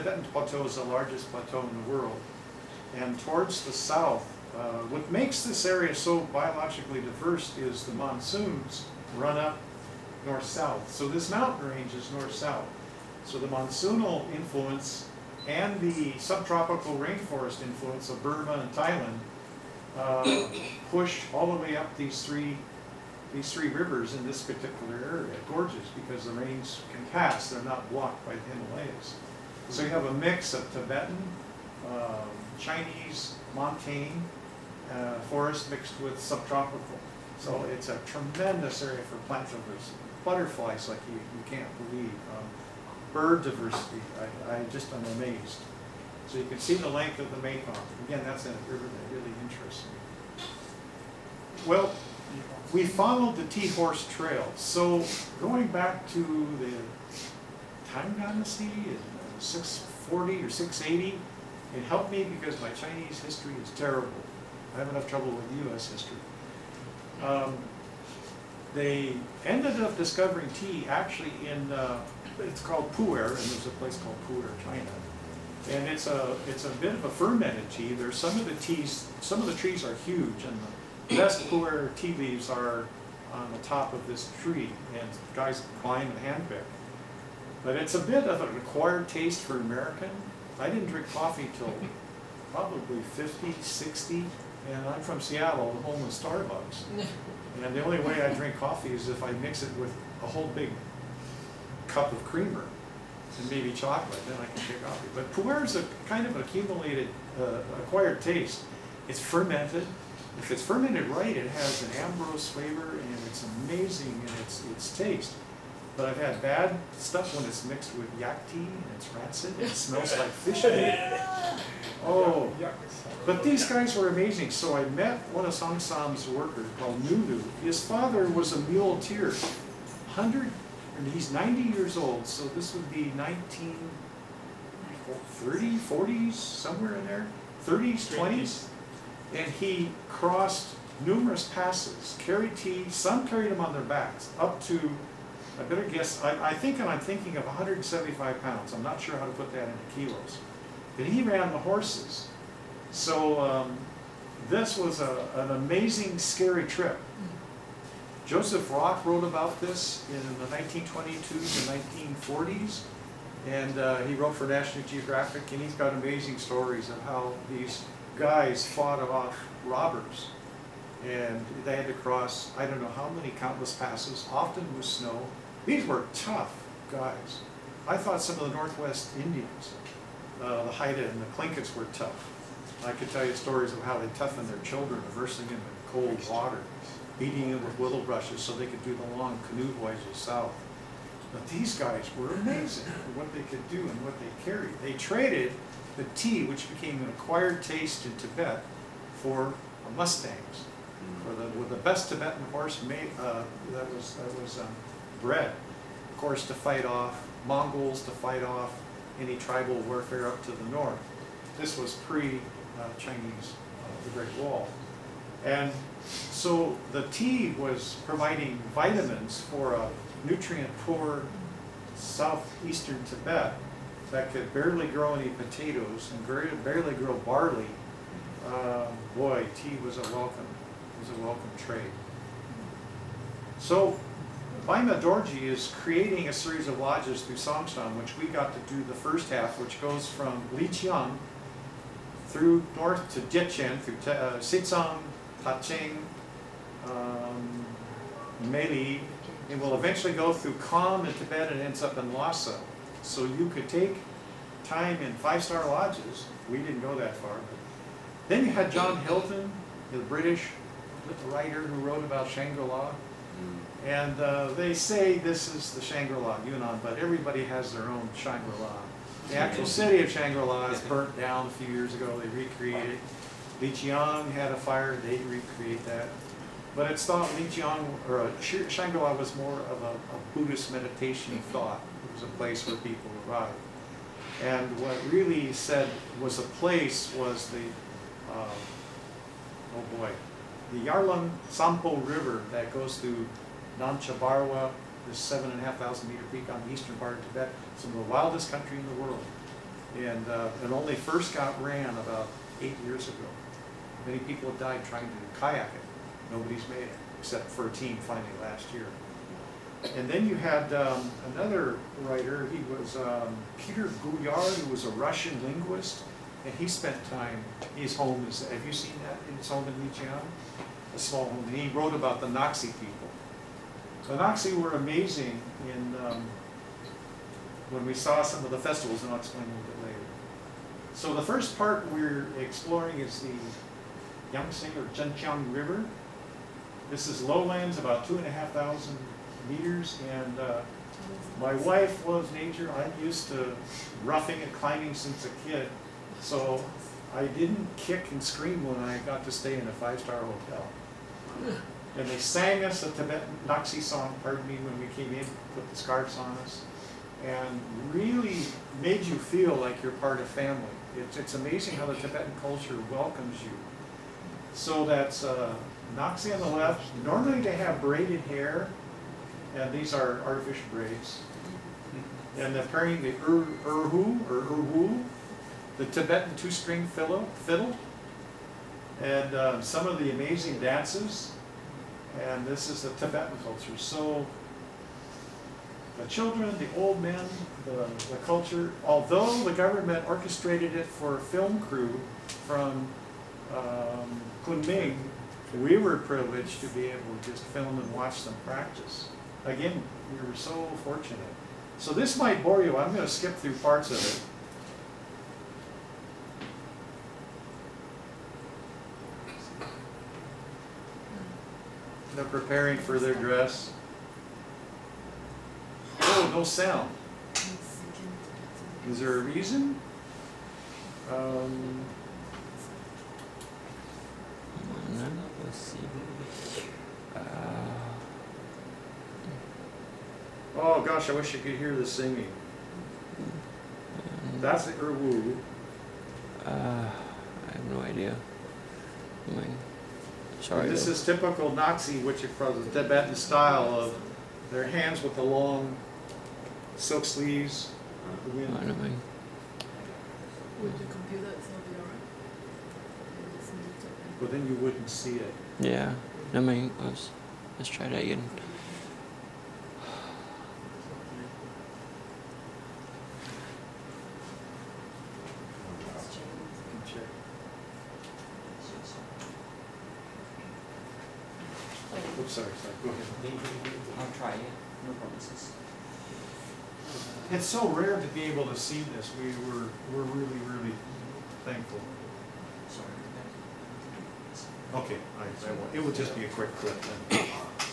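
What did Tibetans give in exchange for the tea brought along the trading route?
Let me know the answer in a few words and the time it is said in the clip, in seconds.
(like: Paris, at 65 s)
Mustangs, at 199 s.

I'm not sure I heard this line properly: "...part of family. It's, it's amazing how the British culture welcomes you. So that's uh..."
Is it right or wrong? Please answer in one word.
wrong.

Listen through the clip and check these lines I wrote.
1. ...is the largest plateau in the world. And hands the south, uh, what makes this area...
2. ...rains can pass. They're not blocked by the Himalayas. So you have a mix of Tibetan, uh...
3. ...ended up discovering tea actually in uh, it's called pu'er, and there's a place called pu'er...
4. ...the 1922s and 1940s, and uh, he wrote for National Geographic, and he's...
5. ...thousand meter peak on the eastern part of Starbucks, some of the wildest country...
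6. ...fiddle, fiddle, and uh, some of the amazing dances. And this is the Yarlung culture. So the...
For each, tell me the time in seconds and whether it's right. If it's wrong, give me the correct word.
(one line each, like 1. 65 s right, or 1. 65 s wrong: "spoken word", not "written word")
1. 0 s wrong: "towards", not "hands"
2. 26 s right
3. 69 s right
4. 160 s right
5. 295 s wrong: "Tibet", not "Starbucks"
6. 376 s wrong: "Tibetan", not "Yarlung".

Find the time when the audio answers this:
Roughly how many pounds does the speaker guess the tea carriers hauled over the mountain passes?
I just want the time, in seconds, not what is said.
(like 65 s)
147 s.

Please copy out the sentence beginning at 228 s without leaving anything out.
Uh, boy, tea was a welcome, was a welcome trade.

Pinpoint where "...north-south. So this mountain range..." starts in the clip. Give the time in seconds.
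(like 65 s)
10 s.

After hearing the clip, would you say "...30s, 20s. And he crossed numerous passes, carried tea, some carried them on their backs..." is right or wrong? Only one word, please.
right.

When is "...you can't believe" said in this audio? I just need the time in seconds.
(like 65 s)
41 s.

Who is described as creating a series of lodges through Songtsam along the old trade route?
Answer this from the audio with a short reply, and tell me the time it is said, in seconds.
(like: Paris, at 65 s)
Baima Dorji, at 234 s.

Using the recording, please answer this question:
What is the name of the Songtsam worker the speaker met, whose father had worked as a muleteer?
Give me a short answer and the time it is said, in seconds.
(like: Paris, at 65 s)
Nunu, at 127 s.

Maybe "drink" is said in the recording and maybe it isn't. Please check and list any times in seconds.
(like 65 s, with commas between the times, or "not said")
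90 s, 98 s, 104 s.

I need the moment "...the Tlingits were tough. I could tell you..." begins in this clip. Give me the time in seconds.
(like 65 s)
181 s.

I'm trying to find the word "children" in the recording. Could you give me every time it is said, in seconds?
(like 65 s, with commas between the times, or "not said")
184 s, 386 s.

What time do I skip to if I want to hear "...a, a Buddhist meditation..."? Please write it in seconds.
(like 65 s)
279 s.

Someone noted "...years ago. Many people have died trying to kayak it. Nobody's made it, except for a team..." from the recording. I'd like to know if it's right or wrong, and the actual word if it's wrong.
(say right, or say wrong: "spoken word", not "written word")
right.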